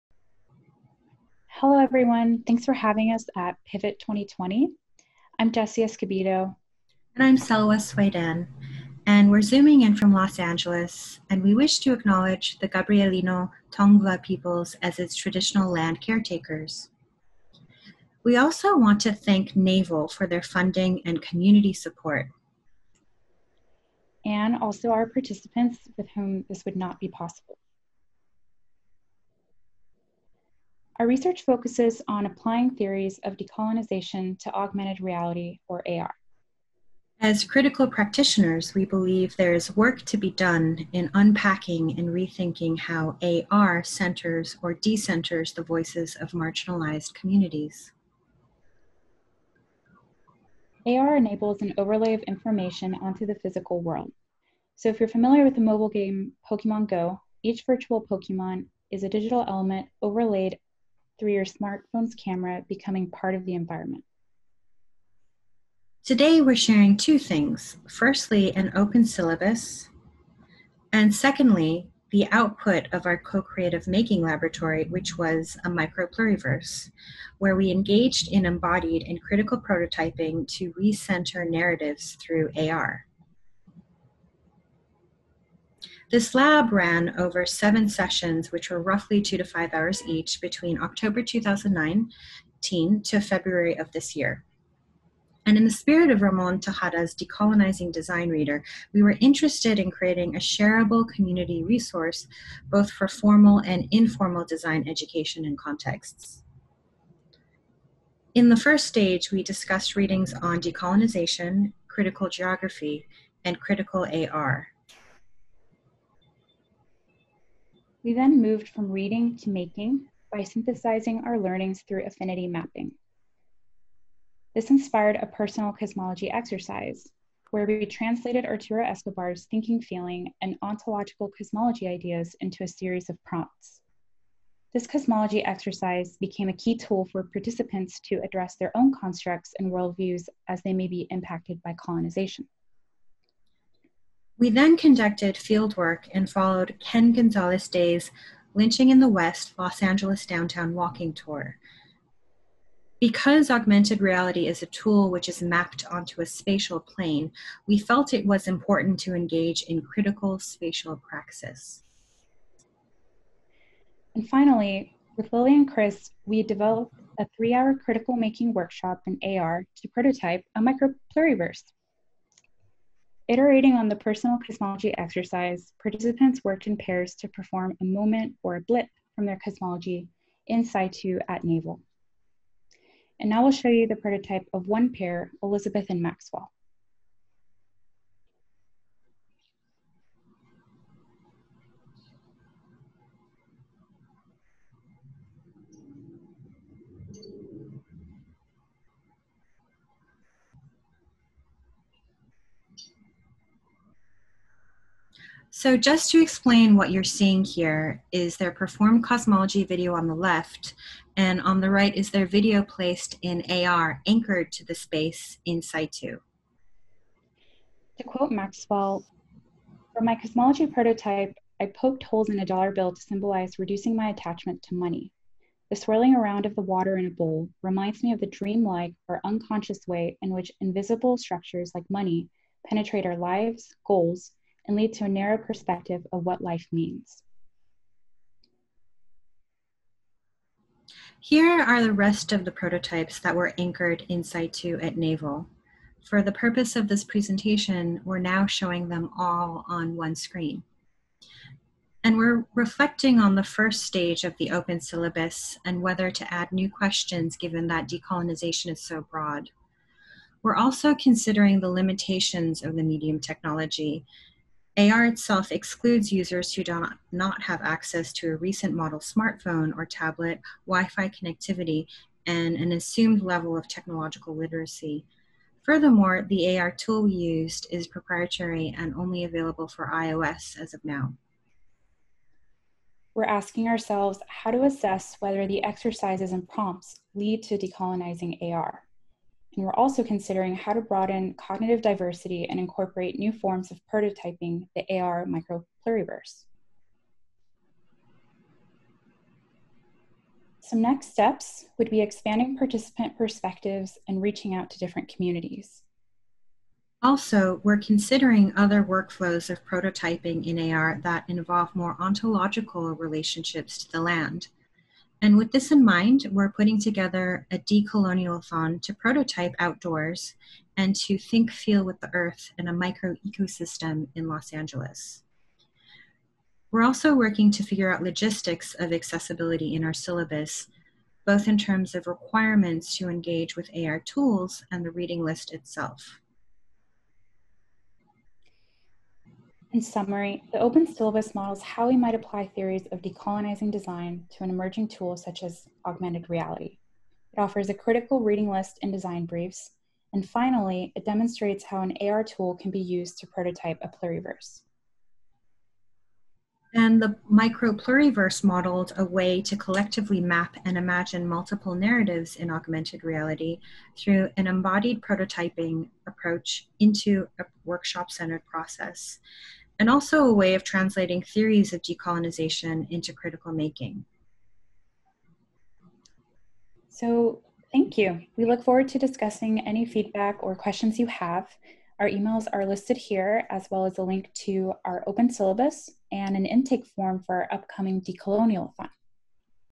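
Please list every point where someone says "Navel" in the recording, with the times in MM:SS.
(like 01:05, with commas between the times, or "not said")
00:19, 03:01, 04:04.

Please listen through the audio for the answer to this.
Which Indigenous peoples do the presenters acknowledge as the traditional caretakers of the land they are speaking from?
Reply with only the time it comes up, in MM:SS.
00:12.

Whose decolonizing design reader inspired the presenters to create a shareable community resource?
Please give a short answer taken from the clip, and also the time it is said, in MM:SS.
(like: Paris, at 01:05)
Ramon Tejada, at 01:36.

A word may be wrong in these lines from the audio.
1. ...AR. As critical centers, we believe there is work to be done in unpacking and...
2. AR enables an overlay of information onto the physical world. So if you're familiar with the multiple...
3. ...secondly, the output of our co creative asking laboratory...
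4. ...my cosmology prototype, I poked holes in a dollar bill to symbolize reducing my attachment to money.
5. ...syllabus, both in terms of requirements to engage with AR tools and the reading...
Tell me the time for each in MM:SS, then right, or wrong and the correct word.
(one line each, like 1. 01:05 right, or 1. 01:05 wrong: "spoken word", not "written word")
1. 00:35 wrong: "practitioners", not "centers"
2. 00:50 wrong: "mobile", not "multiple"
3. 01:11 wrong: "making", not "asking"
4. 03:40 right
5. 05:29 right.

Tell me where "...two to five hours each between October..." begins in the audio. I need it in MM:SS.
01:29.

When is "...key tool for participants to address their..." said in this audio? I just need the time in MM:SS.
02:16.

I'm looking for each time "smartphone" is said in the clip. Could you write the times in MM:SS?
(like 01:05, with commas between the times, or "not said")
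01:01, 04:28.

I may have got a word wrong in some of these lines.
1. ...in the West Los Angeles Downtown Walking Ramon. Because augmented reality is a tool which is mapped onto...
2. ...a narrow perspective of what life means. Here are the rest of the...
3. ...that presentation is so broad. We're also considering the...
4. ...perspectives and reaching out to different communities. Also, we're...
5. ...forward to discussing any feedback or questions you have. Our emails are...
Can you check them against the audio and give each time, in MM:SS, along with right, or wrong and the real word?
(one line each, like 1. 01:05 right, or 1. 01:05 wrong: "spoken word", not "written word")
1. 02:28 wrong: "Tour", not "Ramon"
2. 03:55 right
3. 04:17 wrong: "decolonization", not "presentation"
4. 05:03 right
5. 06:18 right.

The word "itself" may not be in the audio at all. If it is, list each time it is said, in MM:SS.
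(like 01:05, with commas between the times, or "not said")
04:25, 05:35.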